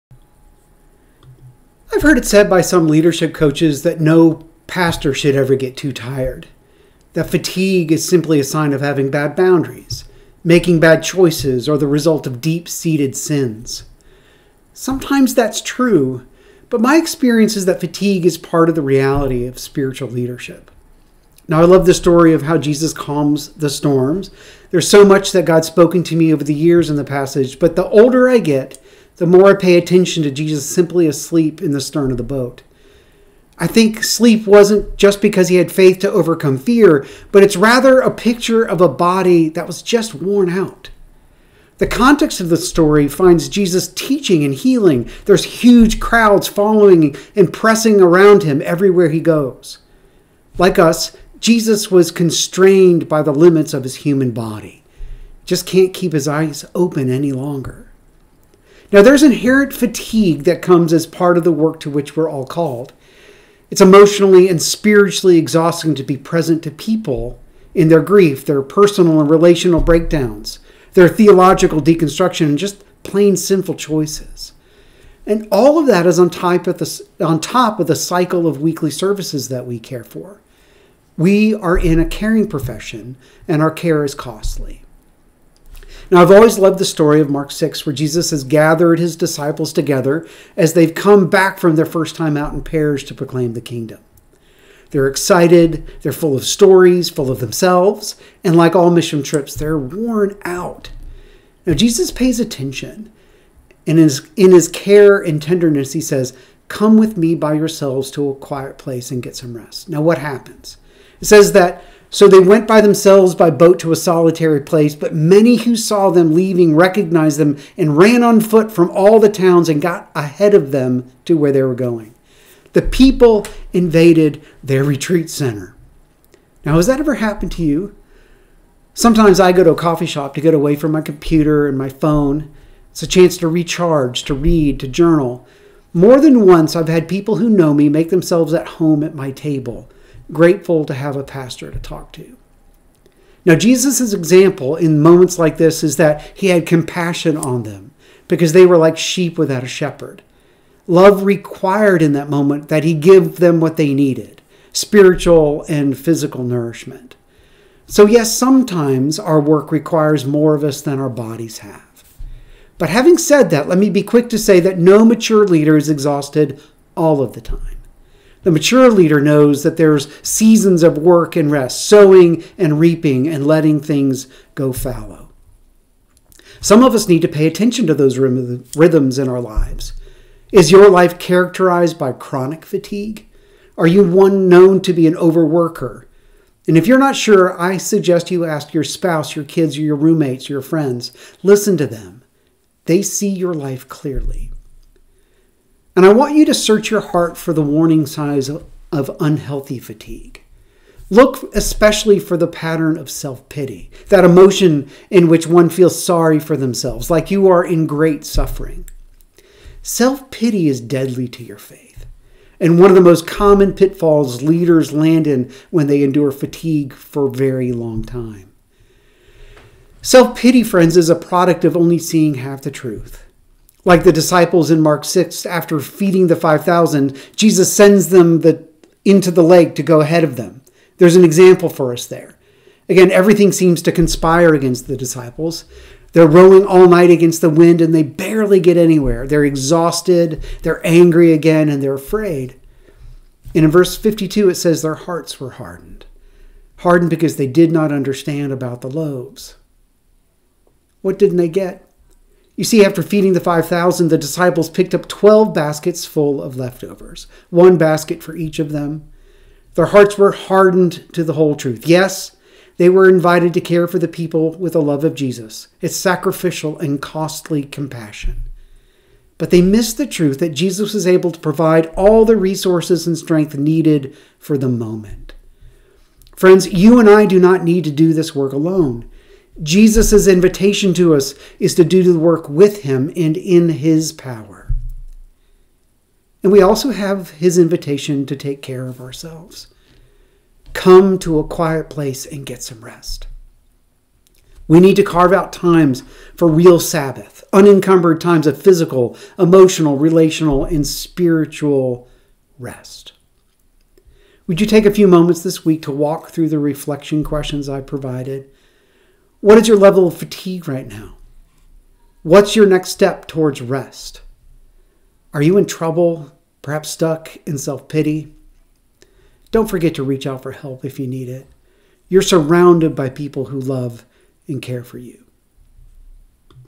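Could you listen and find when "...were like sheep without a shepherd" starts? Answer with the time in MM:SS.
02:28.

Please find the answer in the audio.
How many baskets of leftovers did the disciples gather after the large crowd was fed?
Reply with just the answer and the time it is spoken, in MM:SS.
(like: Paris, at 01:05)
12, at 04:15.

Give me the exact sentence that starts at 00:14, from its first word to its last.
Sometimes that's true, but my experience is that fatigue is part of the reality of spiritual leadership.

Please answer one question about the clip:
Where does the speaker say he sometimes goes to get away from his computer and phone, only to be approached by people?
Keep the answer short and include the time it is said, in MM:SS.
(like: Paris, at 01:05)
a coffee shop, at 02:09.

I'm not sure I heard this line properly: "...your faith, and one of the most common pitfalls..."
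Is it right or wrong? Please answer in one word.
right.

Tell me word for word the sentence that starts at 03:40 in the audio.
Self pity, friends, is a product of only seeing half the truth.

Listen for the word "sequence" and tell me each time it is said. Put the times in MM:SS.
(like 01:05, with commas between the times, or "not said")
not said.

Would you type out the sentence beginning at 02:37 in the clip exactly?
So, yes, sometimes our work requires more of us than our bodies have.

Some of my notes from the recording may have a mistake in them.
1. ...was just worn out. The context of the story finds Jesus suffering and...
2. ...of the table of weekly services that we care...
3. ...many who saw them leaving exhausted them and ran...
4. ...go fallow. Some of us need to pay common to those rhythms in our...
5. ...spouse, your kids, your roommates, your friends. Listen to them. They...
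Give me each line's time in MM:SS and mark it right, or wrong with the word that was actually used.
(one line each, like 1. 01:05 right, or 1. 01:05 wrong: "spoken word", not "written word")
1. 00:39 wrong: "teaching", not "suffering"
2. 01:17 wrong: "cycle", not "table"
3. 01:55 wrong: "recognized", not "exhausted"
4. 02:54 wrong: "attention", not "common"
5. 03:08 right.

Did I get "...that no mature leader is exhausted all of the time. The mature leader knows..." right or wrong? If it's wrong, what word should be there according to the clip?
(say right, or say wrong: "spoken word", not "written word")
right.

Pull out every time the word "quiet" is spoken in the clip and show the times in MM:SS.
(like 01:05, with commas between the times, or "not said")
01:48, 04:51.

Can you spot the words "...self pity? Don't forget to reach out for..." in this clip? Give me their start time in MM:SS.
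05:17.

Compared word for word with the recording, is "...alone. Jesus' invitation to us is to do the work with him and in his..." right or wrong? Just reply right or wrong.
right.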